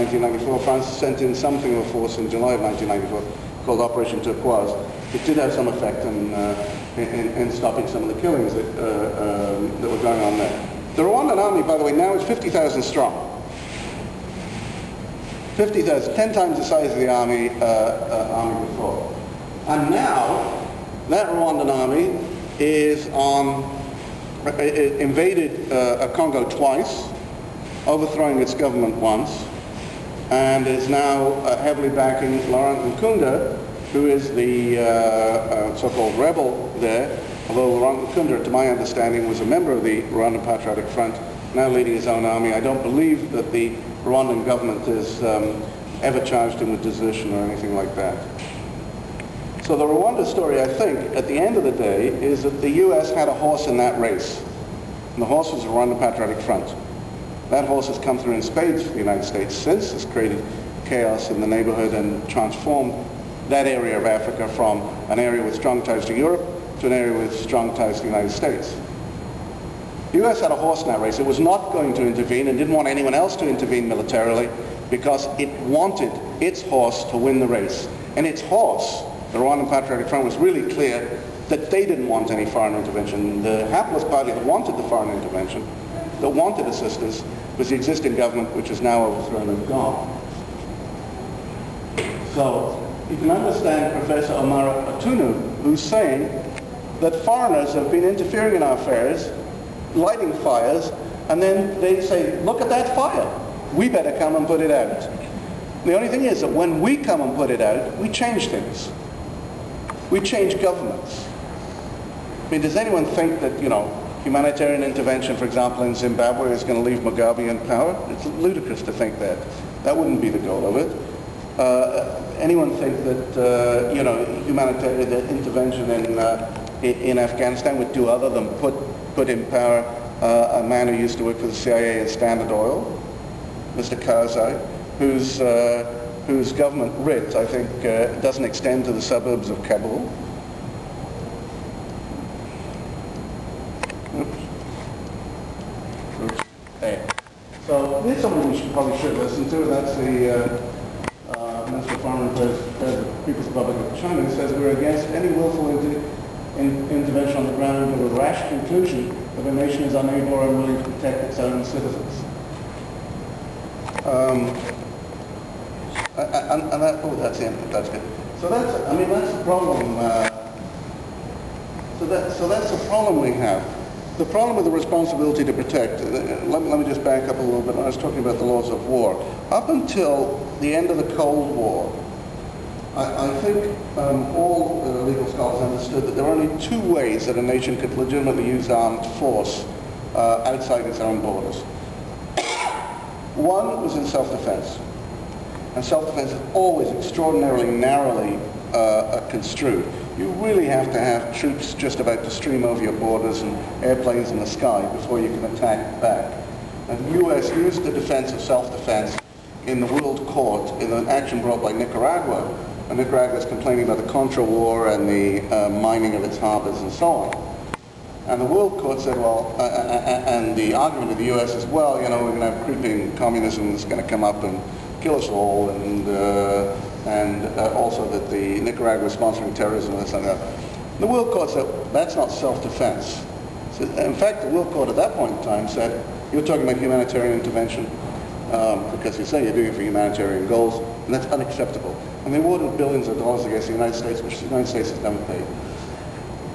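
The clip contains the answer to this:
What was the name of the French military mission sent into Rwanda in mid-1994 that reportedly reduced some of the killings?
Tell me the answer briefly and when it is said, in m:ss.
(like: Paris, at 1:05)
Operation Turquoise, at 0:03.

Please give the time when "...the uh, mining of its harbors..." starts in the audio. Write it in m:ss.
3:35.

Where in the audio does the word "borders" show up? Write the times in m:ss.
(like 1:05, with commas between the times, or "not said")
3:11, 3:22.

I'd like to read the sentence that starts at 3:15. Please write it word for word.
And self-defense is always extraordinarily narrowly uh, uh, construed.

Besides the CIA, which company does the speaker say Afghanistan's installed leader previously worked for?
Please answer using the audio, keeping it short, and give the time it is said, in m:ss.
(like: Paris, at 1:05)
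Standard Oil, at 2:12.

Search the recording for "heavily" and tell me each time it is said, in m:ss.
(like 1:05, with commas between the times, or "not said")
0:31.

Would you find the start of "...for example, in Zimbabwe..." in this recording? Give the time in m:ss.
1:55.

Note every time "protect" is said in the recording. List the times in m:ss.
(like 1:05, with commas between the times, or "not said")
2:40, 2:55.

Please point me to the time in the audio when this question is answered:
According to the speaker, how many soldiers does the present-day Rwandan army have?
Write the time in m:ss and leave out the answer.
0:12.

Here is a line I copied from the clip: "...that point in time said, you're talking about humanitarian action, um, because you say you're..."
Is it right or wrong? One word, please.
wrong.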